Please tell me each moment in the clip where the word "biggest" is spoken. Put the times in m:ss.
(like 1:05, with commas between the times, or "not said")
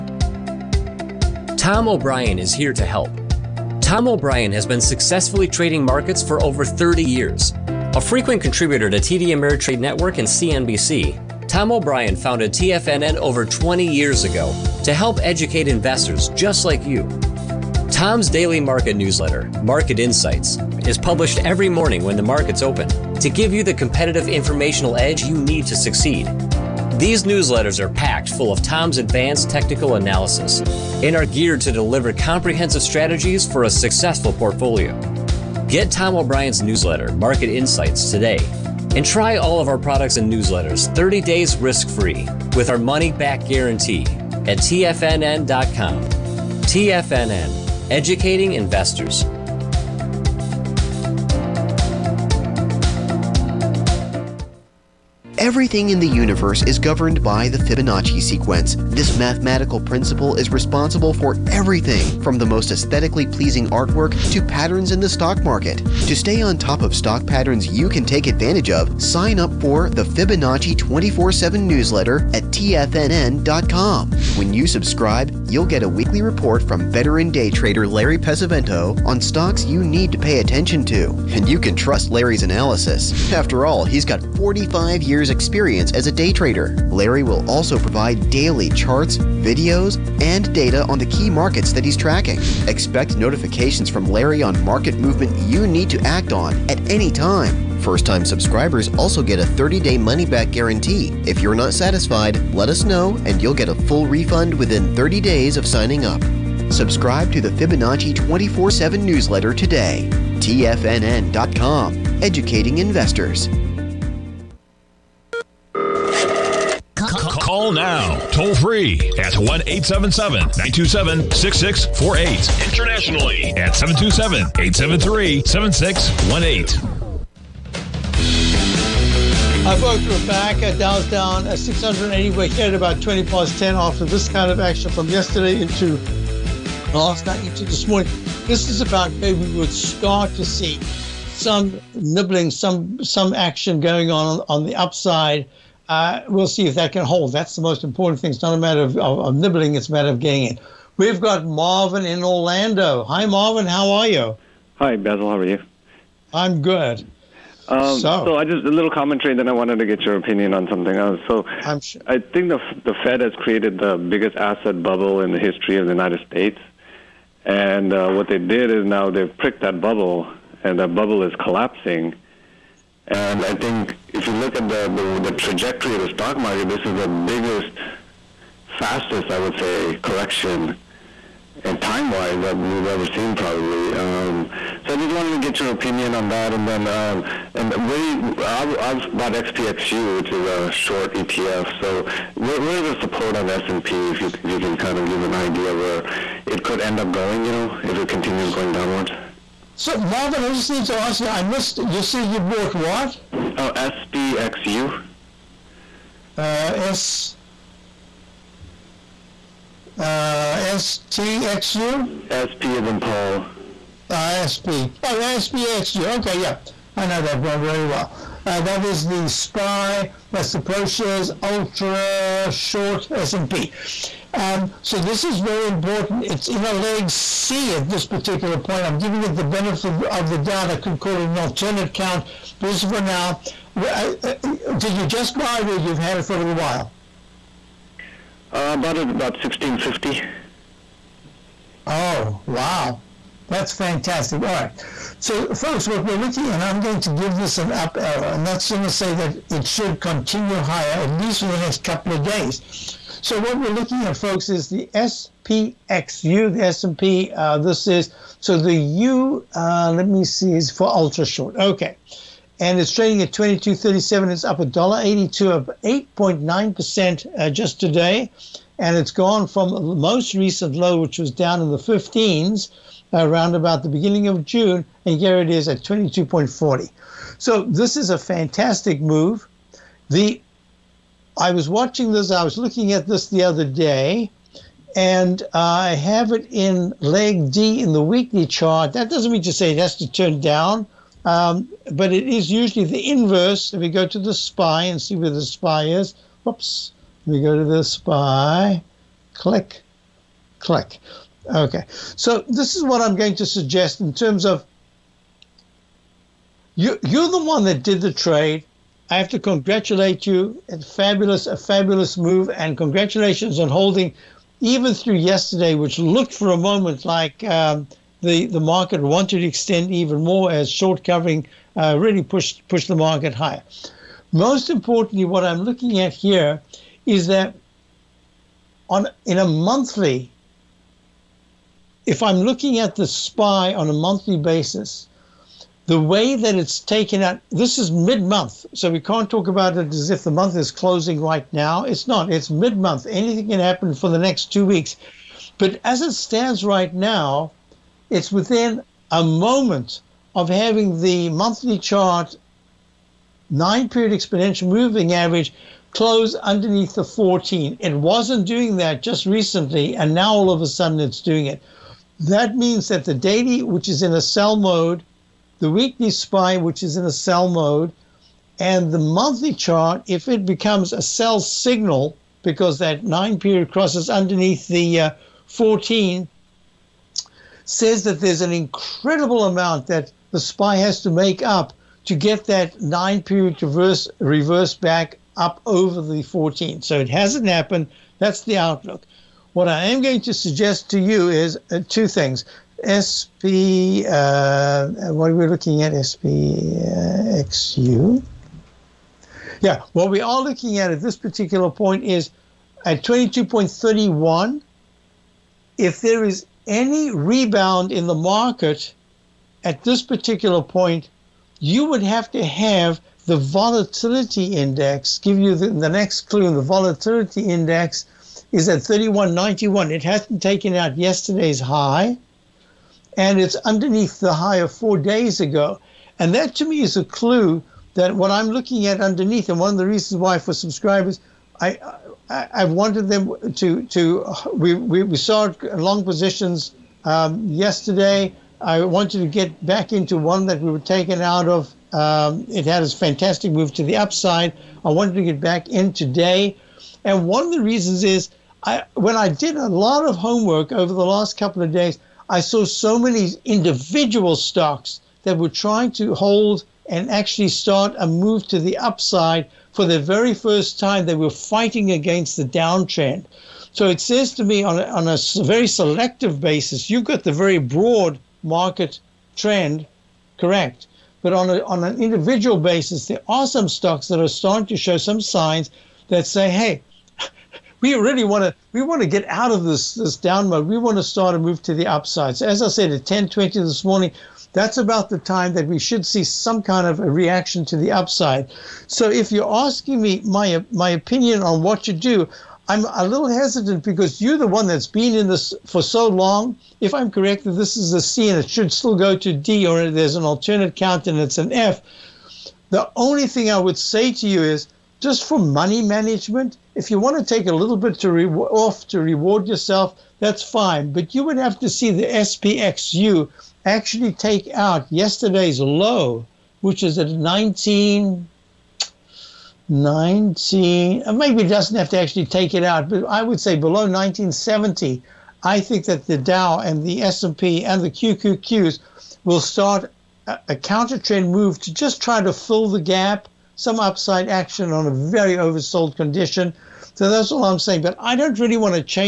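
2:43, 2:57.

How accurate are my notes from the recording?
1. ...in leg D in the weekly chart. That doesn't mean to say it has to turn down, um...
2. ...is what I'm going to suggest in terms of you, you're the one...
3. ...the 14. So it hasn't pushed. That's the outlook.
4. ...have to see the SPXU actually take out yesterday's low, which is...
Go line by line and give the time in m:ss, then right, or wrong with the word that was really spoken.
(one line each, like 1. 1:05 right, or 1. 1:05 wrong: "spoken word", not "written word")
1. 4:46 right
2. 5:02 right
3. 6:26 wrong: "happened", not "pushed"
4. 8:31 right.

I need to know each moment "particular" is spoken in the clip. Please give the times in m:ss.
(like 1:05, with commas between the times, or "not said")
3:48, 6:41, 6:50.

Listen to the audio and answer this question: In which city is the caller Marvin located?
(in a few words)
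Orlando.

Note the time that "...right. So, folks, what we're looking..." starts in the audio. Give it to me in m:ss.
4:04.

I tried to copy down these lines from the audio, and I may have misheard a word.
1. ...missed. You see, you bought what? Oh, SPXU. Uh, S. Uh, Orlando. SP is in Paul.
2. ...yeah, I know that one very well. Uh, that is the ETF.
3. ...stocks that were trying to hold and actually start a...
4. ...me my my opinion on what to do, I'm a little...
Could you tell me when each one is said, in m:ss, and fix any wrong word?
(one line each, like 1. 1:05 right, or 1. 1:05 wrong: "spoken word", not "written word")
1. 3:21 wrong: "STXU", not "Orlando"
2. 3:36 wrong: "SPY", not "ETF"
3. 7:34 right
4. 8:10 right.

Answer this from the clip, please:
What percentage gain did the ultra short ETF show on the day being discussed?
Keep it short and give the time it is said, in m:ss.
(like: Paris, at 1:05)
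8.9 percent, at 4:25.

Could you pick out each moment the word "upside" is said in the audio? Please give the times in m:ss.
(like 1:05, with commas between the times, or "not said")
2:24, 7:23, 7:38, 8:01, 8:07, 8:53.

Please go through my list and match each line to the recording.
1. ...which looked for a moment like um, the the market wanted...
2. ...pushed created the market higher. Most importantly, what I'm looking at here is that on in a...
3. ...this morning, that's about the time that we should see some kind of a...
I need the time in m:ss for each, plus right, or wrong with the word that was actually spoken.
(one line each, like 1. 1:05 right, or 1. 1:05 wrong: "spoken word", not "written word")
1. 5:15 right
2. 5:22 wrong: "pushed", not "created"
3. 8:03 right.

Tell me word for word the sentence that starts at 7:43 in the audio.
So it says to me on a, on a very selective basis, you've got the very broad market trend correct.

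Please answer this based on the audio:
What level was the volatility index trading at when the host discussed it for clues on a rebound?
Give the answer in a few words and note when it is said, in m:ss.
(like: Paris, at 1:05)
31.91, at 6:58.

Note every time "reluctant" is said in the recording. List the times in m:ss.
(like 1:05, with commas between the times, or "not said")
not said.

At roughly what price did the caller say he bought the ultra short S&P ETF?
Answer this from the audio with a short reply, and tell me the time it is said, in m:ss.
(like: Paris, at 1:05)
16.50, at 3:59.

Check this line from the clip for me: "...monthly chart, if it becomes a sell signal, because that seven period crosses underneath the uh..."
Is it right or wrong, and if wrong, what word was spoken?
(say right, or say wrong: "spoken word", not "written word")
wrong: "nine", not "seven".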